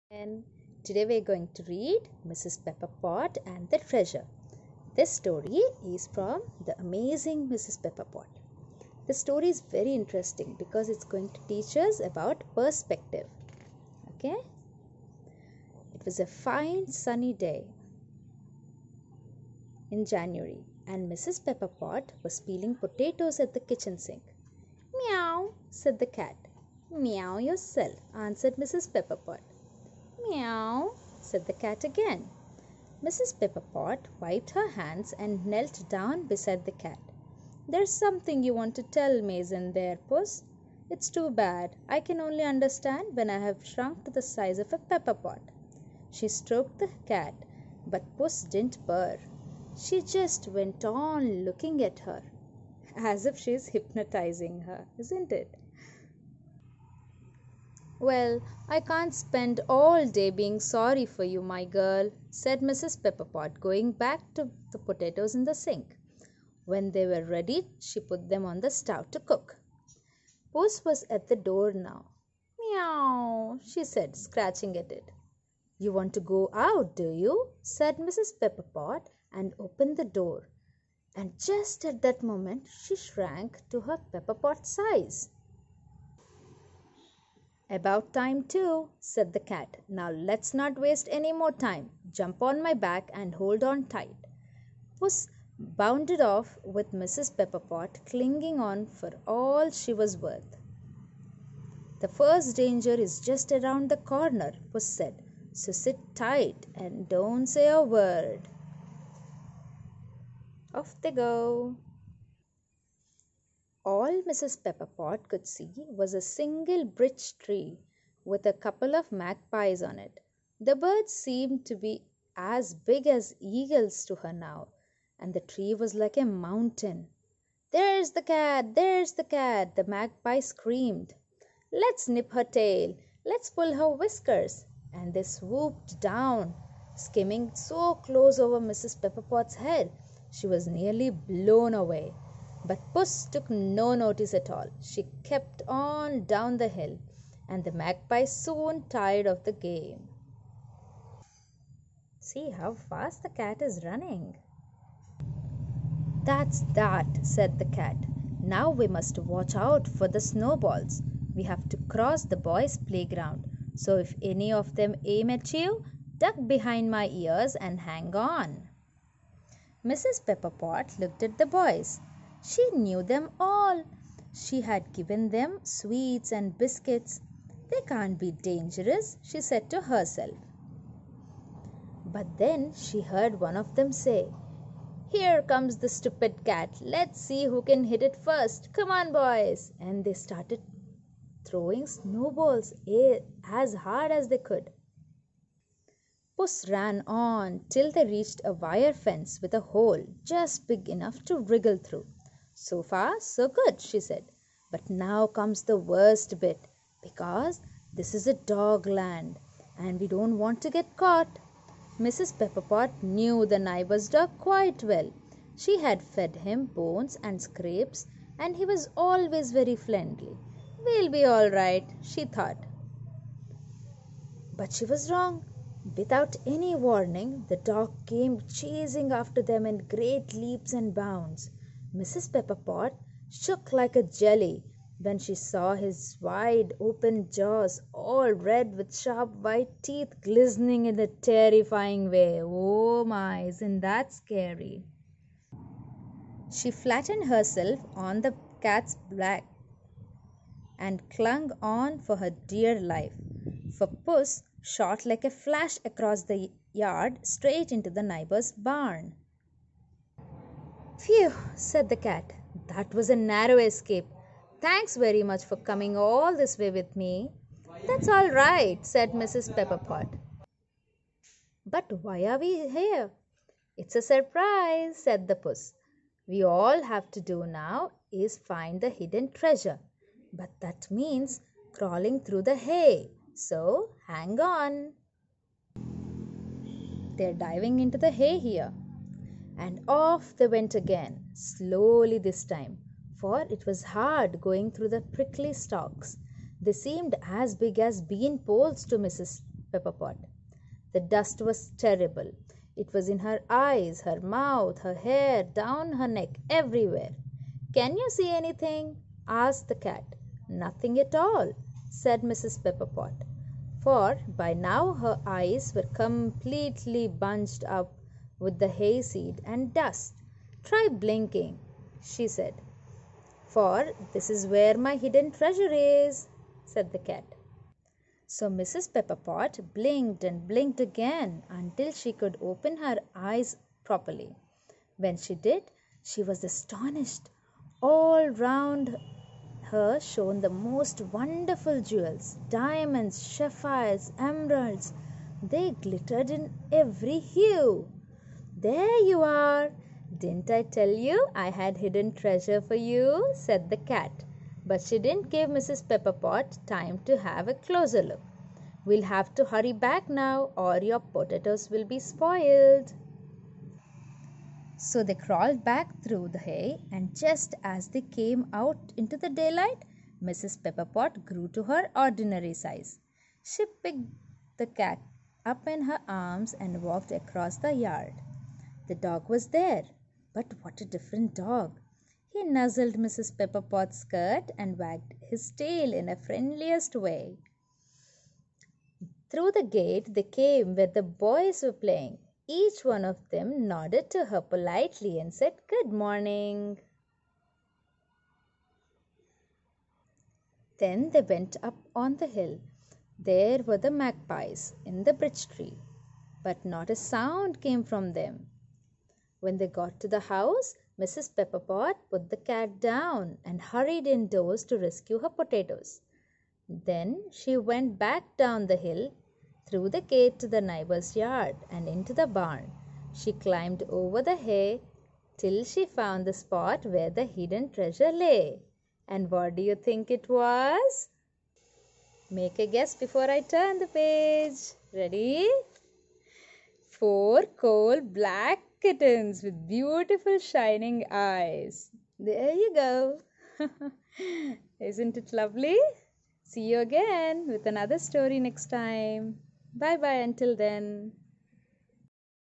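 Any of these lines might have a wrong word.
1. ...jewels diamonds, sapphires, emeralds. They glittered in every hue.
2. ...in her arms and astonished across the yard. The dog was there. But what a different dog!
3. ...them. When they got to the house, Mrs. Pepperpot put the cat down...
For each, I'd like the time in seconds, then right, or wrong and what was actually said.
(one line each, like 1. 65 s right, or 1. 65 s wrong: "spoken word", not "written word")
1. 341 s right
2. 375 s wrong: "walked", not "astonished"
3. 408 s right.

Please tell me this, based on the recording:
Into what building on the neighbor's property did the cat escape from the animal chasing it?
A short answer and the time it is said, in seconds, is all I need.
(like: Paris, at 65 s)
the neighbor's barn, at 258 s.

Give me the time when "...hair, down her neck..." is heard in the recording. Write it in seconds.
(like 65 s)
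304 s.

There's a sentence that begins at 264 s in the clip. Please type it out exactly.
Thanks very much for coming all this way with me.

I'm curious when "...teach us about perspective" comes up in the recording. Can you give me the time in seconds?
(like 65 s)
11 s.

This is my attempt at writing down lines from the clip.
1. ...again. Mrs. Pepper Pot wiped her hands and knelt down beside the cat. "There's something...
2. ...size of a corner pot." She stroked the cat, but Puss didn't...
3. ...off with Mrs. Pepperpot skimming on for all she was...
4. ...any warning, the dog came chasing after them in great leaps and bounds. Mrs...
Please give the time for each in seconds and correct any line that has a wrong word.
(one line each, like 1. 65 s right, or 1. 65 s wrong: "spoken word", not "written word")
1. 31 s right
2. 44 s wrong: "pepper", not "corner"
3. 96 s wrong: "clinging", not "skimming"
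4. 226 s right.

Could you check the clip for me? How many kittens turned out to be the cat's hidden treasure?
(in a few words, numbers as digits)
4.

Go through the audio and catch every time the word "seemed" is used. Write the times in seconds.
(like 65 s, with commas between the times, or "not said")
121 s, 296 s.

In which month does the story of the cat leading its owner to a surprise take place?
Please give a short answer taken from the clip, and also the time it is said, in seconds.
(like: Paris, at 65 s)
January, at 20 s.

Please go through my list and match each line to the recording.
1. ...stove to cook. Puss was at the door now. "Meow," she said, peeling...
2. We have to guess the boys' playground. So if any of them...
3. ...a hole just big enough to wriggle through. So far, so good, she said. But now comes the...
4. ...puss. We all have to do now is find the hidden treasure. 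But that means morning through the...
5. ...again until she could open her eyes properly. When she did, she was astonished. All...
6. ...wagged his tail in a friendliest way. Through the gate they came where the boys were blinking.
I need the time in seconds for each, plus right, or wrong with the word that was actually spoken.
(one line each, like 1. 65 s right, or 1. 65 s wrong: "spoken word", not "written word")
1. 68 s wrong: "scratching", not "peeling"
2. 161 s wrong: "cross", not "guess"
3. 199 s right
4. 275 s wrong: "crawling", not "morning"
5. 330 s right
6. 384 s wrong: "playing", not "blinking".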